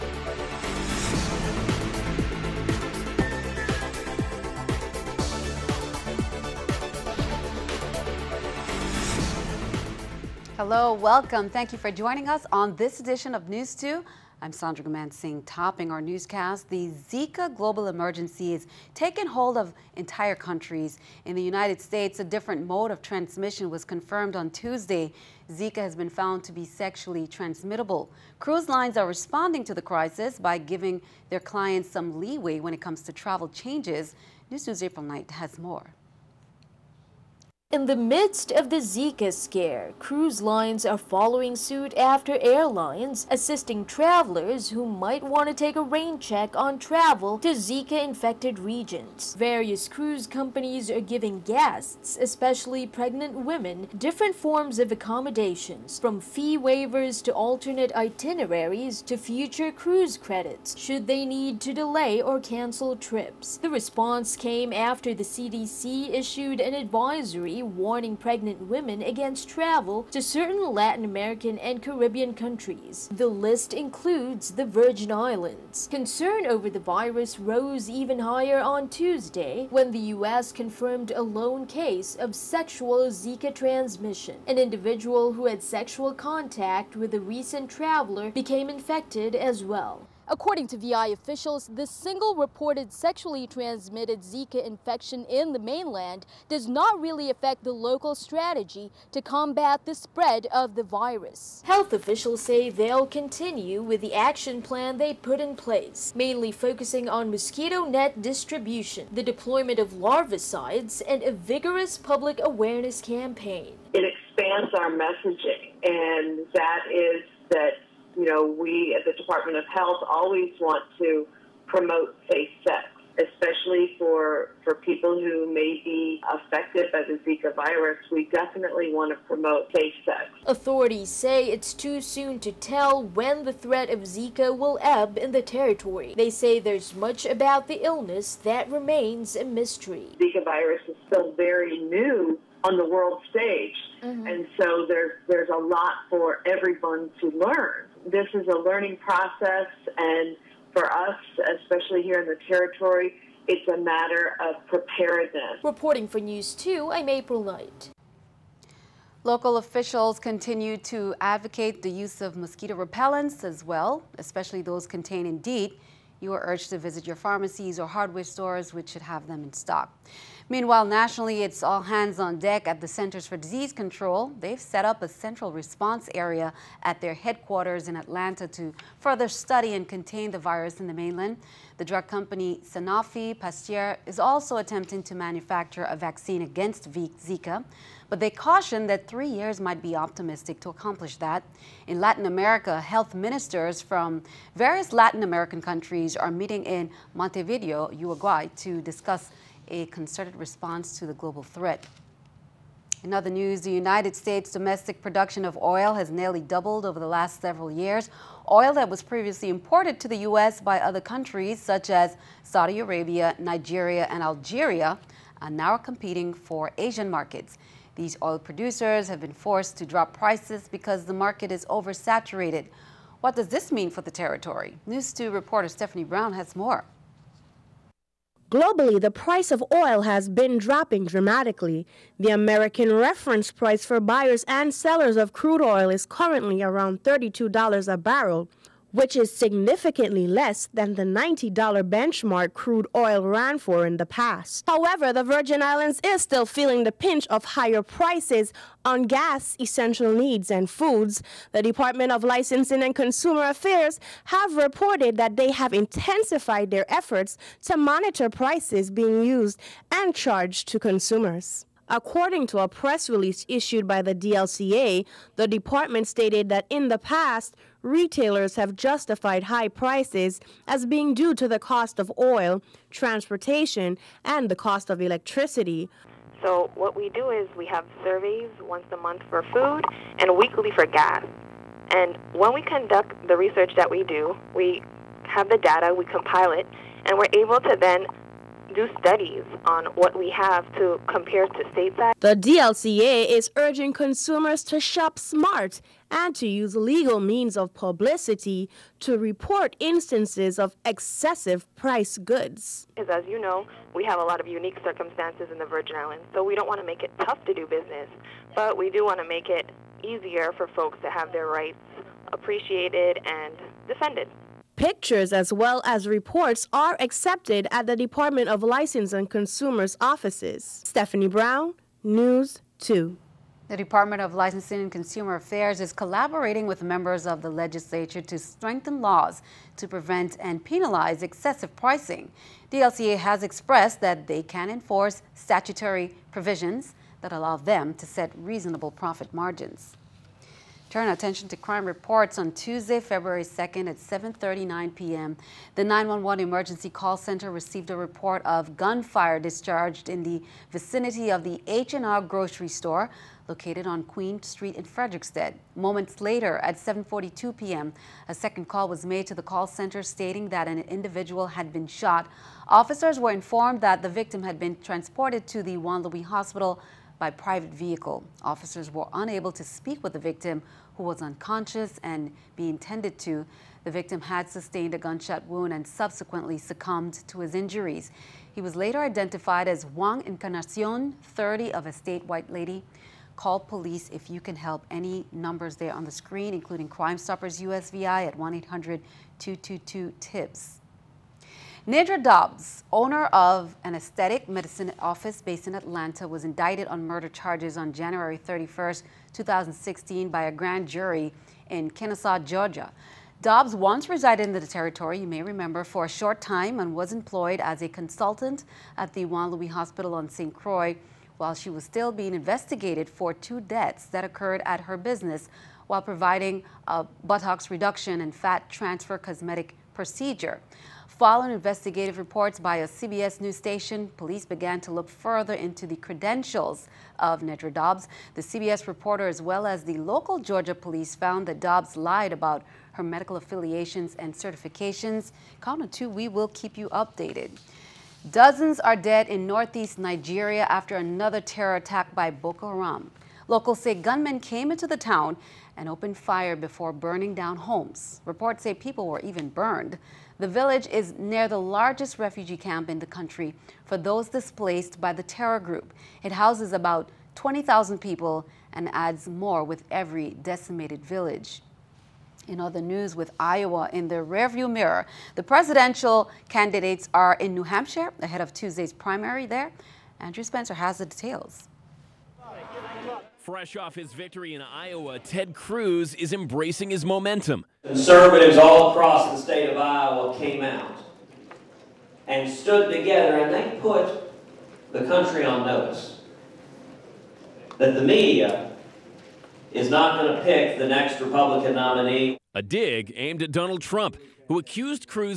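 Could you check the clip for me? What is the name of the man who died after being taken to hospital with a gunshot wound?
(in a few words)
Juan Encarnacion.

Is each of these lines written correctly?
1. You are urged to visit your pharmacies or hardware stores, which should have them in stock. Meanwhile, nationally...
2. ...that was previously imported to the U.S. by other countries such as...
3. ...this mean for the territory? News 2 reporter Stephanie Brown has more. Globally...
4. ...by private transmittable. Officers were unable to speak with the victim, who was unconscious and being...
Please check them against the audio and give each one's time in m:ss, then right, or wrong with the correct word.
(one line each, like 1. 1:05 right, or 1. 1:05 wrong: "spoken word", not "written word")
1. 2:46 right
2. 3:28 right
3. 3:43 right
4. 6:07 wrong: "vehicle", not "transmittable".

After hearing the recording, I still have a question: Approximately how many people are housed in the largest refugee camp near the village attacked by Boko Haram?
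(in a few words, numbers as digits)
20,000.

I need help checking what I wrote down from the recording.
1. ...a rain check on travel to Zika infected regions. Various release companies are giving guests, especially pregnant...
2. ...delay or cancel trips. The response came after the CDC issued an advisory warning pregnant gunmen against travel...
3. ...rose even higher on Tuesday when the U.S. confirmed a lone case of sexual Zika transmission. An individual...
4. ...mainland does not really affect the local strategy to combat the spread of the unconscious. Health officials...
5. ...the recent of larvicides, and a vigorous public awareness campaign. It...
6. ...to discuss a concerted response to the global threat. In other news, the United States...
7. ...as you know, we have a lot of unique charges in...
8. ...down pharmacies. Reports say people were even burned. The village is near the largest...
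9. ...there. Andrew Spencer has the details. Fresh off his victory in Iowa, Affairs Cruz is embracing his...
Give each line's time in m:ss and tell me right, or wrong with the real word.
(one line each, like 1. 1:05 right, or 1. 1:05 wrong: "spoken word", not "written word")
1. 0:45 wrong: "cruise", not "release"
2. 1:01 wrong: "women", not "gunmen"
3. 1:17 right
4. 1:35 wrong: "virus", not "unconscious"
5. 1:49 wrong: "deployment", not "recent"
6. 3:18 right
7. 5:03 wrong: "circumstances", not "charges"
8. 7:27 wrong: "homes", not "pharmacies"
9. 7:49 wrong: "Ted", not "Affairs".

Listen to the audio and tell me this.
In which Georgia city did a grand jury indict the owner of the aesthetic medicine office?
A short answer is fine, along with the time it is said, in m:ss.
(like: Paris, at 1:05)
Kennesaw, at 6:41.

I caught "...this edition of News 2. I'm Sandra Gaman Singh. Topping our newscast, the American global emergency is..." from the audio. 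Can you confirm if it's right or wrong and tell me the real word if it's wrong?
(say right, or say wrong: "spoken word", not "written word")
wrong: "Zika", not "American".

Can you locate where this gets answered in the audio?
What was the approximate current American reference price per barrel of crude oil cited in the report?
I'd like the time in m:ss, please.
3:57.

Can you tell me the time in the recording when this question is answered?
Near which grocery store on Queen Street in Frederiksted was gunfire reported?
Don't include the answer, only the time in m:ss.
5:51.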